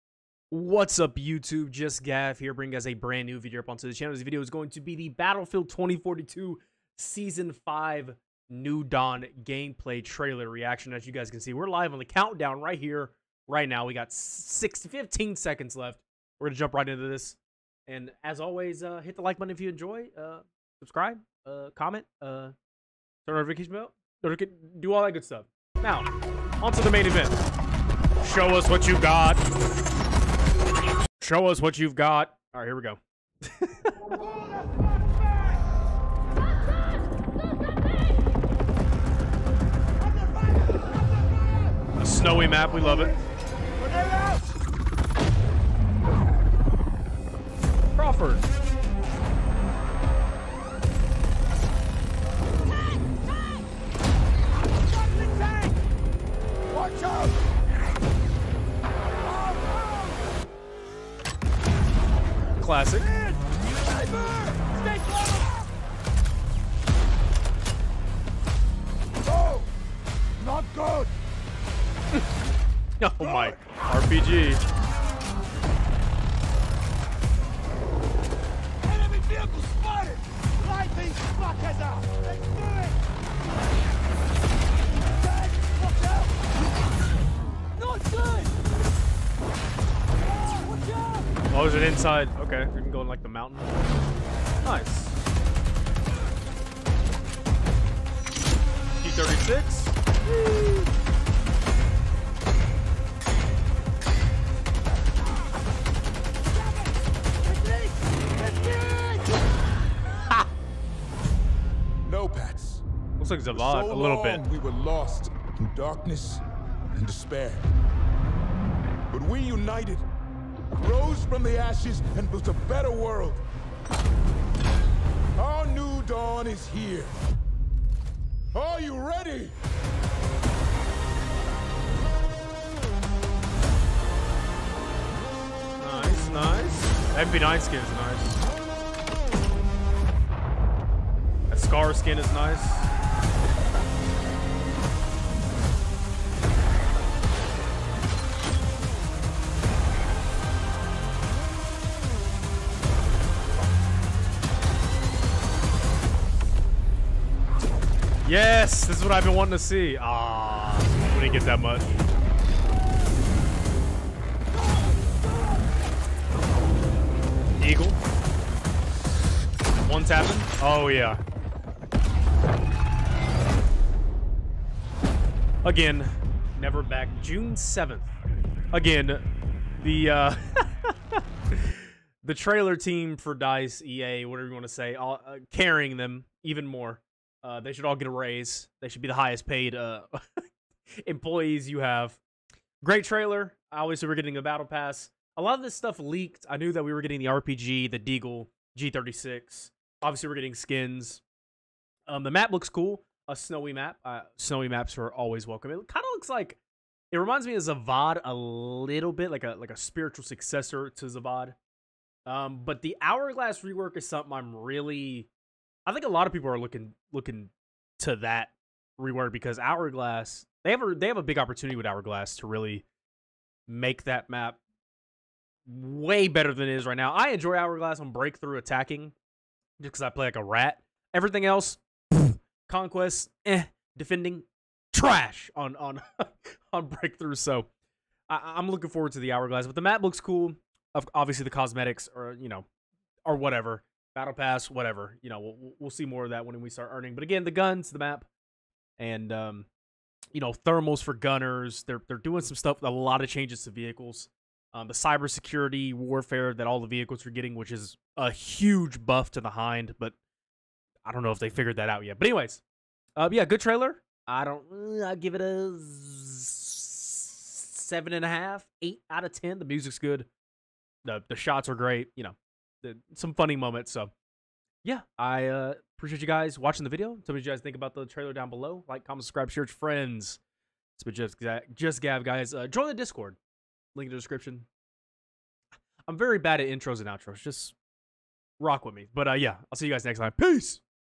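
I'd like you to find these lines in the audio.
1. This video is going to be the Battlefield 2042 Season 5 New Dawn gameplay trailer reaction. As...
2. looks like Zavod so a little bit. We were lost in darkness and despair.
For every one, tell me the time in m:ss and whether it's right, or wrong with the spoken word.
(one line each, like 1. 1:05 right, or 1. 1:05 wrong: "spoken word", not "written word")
1. 0:04 right
2. 1:53 right.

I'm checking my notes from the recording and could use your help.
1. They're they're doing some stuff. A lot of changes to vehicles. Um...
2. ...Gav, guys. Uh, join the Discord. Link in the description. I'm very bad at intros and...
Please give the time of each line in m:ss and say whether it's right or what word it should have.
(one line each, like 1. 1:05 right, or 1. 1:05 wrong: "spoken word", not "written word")
1. 4:11 right
2. 4:42 right.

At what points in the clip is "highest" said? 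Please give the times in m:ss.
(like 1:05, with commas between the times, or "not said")
3:09.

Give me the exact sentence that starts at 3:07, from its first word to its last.
Uh, they should all get a raise.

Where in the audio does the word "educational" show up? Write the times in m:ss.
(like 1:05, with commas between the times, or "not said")
not said.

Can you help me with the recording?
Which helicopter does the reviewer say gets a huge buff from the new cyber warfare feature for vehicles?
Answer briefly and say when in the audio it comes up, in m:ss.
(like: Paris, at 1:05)
Hind, at 4:19.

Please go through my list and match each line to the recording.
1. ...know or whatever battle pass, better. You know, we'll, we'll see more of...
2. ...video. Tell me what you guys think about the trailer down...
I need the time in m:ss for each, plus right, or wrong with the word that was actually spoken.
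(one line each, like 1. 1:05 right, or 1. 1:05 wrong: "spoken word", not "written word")
1. 4:02 wrong: "whatever", not "better"
2. 4:36 right.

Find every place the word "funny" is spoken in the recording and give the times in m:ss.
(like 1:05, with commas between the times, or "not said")
4:33.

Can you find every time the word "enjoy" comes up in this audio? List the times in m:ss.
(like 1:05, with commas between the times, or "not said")
0:19, 3:47.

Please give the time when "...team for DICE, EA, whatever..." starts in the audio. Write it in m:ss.
3:02.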